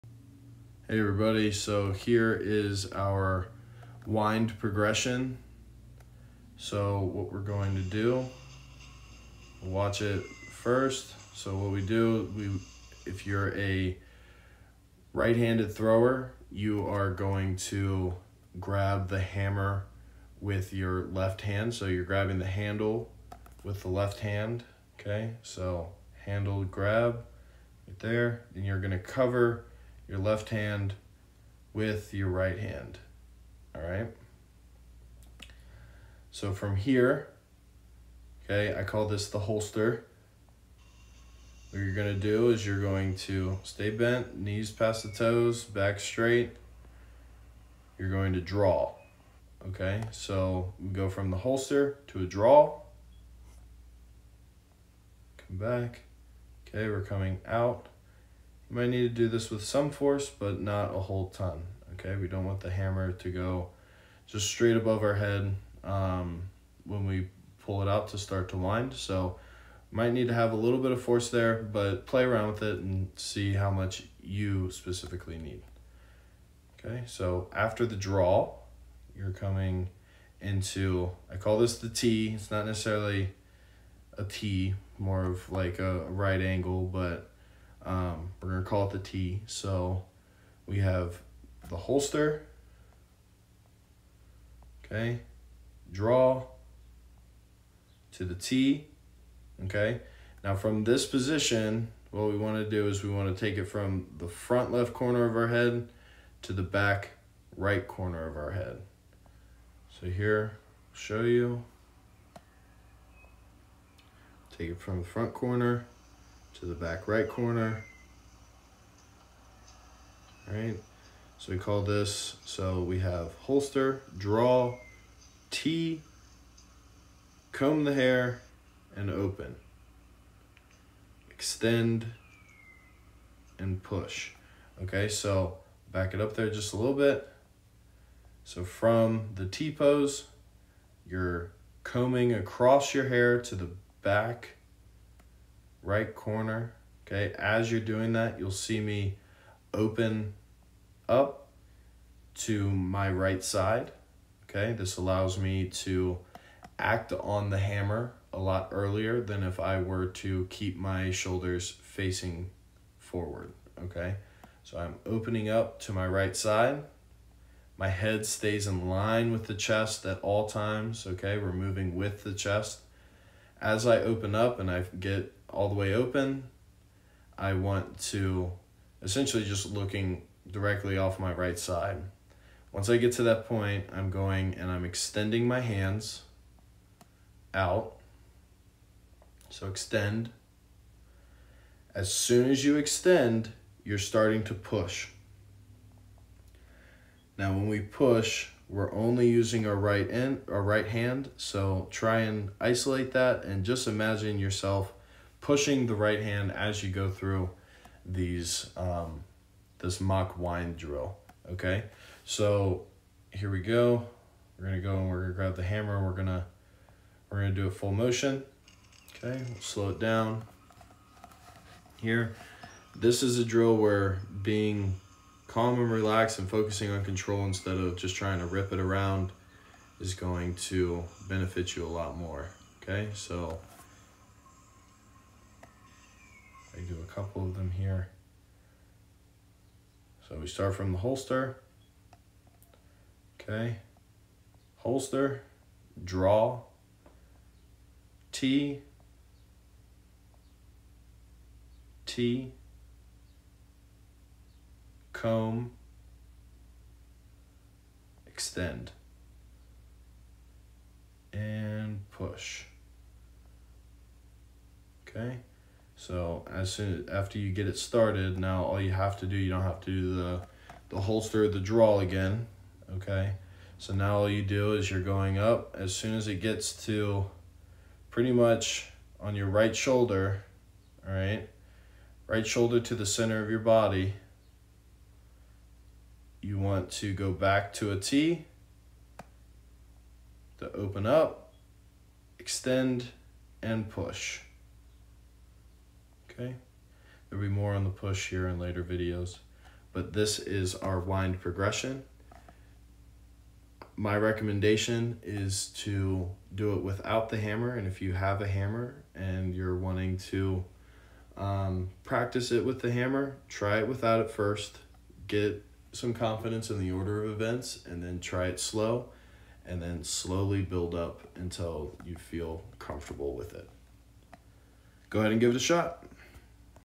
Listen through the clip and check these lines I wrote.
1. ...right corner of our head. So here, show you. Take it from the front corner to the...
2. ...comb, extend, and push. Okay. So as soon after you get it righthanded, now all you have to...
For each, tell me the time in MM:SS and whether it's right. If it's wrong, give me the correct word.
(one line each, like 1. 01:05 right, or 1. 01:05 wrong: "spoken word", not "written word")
1. 01:47 right
2. 04:15 wrong: "started", not "righthanded".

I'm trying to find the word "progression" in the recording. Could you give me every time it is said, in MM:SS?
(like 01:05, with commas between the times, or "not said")
00:04, 05:01.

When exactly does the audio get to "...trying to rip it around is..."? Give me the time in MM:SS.
03:48.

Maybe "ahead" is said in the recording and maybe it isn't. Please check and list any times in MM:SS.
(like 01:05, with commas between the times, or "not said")
05:25.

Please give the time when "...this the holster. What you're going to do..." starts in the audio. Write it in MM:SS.
00:39.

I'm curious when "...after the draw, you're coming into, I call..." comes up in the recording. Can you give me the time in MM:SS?
01:17.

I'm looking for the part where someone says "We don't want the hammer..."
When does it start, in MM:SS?
01:02.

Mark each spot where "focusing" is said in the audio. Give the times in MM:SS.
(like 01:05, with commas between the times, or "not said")
03:46.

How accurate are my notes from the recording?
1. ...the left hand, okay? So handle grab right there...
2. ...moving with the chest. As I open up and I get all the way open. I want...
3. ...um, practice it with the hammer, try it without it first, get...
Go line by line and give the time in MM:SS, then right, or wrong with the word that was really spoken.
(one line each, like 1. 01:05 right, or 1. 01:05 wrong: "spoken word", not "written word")
1. 00:23 right
2. 02:51 right
3. 05:11 right.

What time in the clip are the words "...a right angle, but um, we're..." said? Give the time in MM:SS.
01:25.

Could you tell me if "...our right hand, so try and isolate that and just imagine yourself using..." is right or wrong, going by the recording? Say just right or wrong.
wrong.